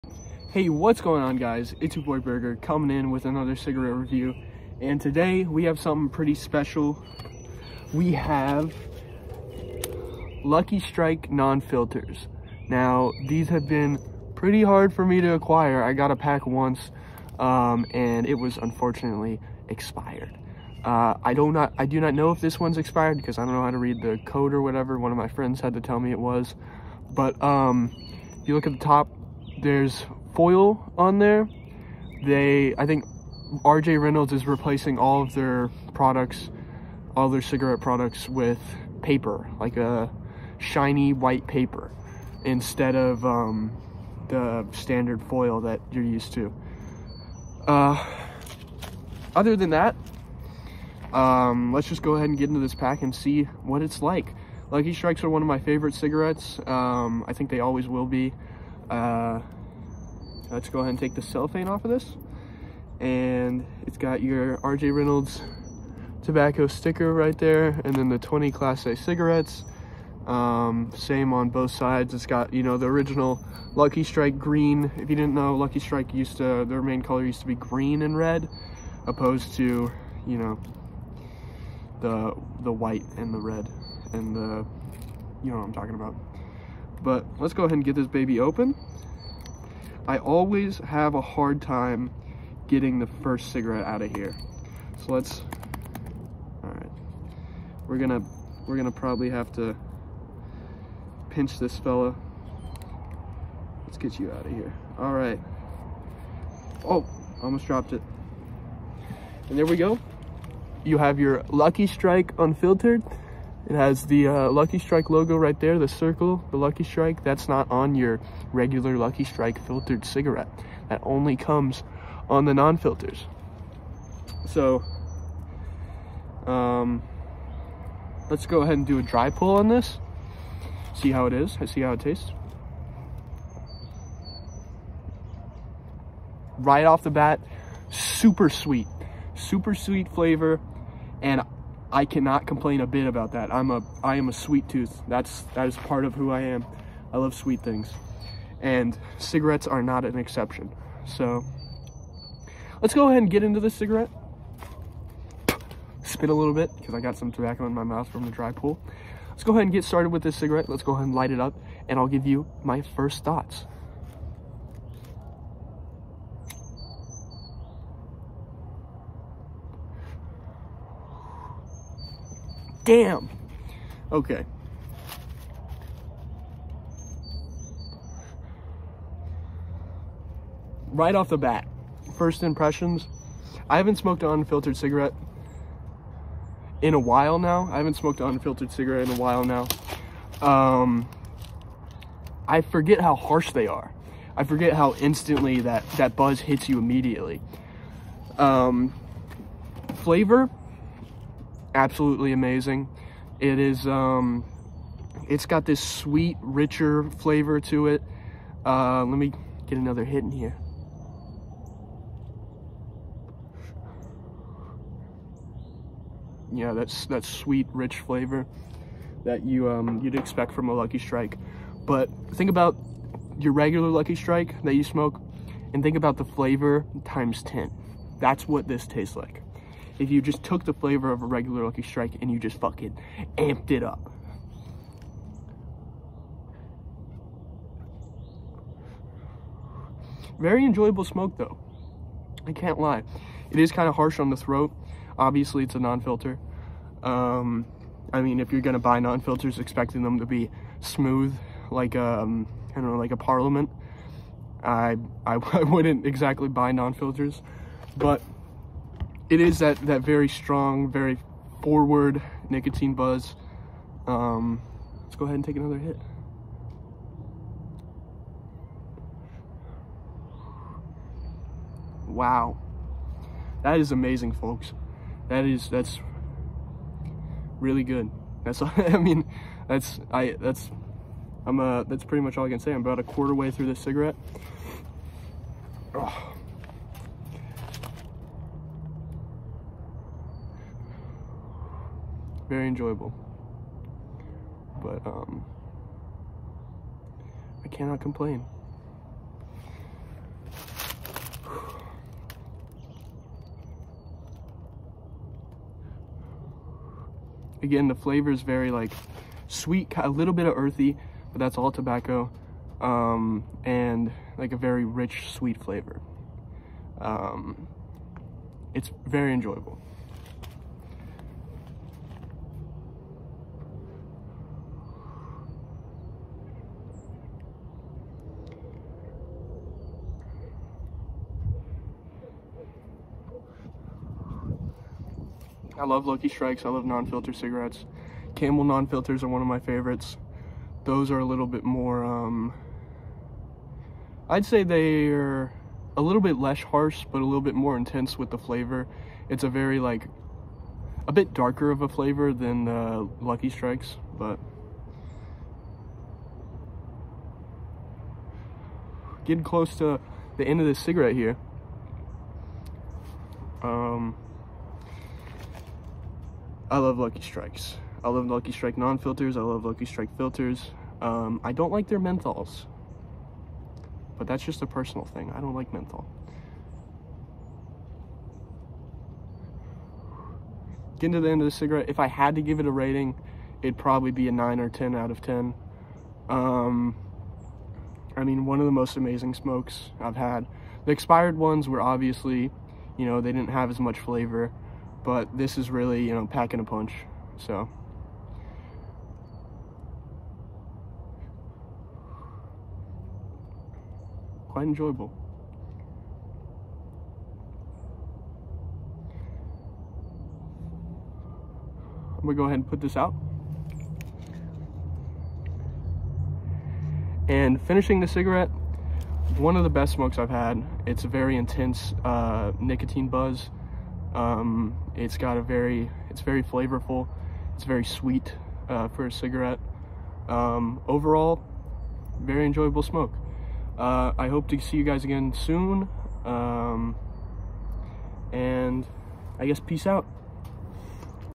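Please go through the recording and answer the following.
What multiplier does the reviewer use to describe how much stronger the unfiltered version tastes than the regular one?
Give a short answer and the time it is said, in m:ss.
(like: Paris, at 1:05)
10, at 3:47.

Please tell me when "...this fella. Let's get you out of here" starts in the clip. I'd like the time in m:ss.
1:41.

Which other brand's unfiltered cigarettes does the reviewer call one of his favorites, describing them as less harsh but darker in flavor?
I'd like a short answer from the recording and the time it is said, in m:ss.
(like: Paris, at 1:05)
Camel, at 5:38.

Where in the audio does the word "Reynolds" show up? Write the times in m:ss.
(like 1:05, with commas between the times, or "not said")
0:34, 1:04.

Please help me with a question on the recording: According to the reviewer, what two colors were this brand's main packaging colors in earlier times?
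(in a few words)
Green and red.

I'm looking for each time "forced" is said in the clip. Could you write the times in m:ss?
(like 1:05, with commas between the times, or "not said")
not said.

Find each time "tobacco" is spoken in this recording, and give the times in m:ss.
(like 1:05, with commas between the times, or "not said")
1:06, 2:37, 5:11.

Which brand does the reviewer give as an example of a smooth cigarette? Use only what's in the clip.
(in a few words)
Parliament.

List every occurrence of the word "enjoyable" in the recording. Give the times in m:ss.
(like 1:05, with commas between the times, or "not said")
4:00, 4:52, 5:19, 6:44, 7:12.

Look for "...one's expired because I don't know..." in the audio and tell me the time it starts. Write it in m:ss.
0:22.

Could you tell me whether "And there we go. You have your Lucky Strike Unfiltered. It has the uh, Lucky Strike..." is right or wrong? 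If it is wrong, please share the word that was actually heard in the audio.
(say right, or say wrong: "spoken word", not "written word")
right.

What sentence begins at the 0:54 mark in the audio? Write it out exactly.
Lucky Strikes are one of my favorite cigarettes.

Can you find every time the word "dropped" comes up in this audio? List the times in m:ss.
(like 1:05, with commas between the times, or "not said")
1:47.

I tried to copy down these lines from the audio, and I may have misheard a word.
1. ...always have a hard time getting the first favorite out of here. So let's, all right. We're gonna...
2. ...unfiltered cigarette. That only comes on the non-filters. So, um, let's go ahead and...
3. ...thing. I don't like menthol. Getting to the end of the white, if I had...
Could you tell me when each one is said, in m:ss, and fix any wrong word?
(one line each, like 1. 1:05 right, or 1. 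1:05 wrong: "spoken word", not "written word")
1. 1:30 wrong: "cigarette", not "favorite"
2. 1:59 wrong: "filtered", not "unfiltered"
3. 6:15 wrong: "cigarette", not "white".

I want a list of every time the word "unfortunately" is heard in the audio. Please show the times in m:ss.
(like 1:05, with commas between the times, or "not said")
0:18.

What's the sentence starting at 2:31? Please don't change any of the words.
So let's go ahead and get into this cigarette.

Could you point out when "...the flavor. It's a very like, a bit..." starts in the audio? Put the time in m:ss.
5:48.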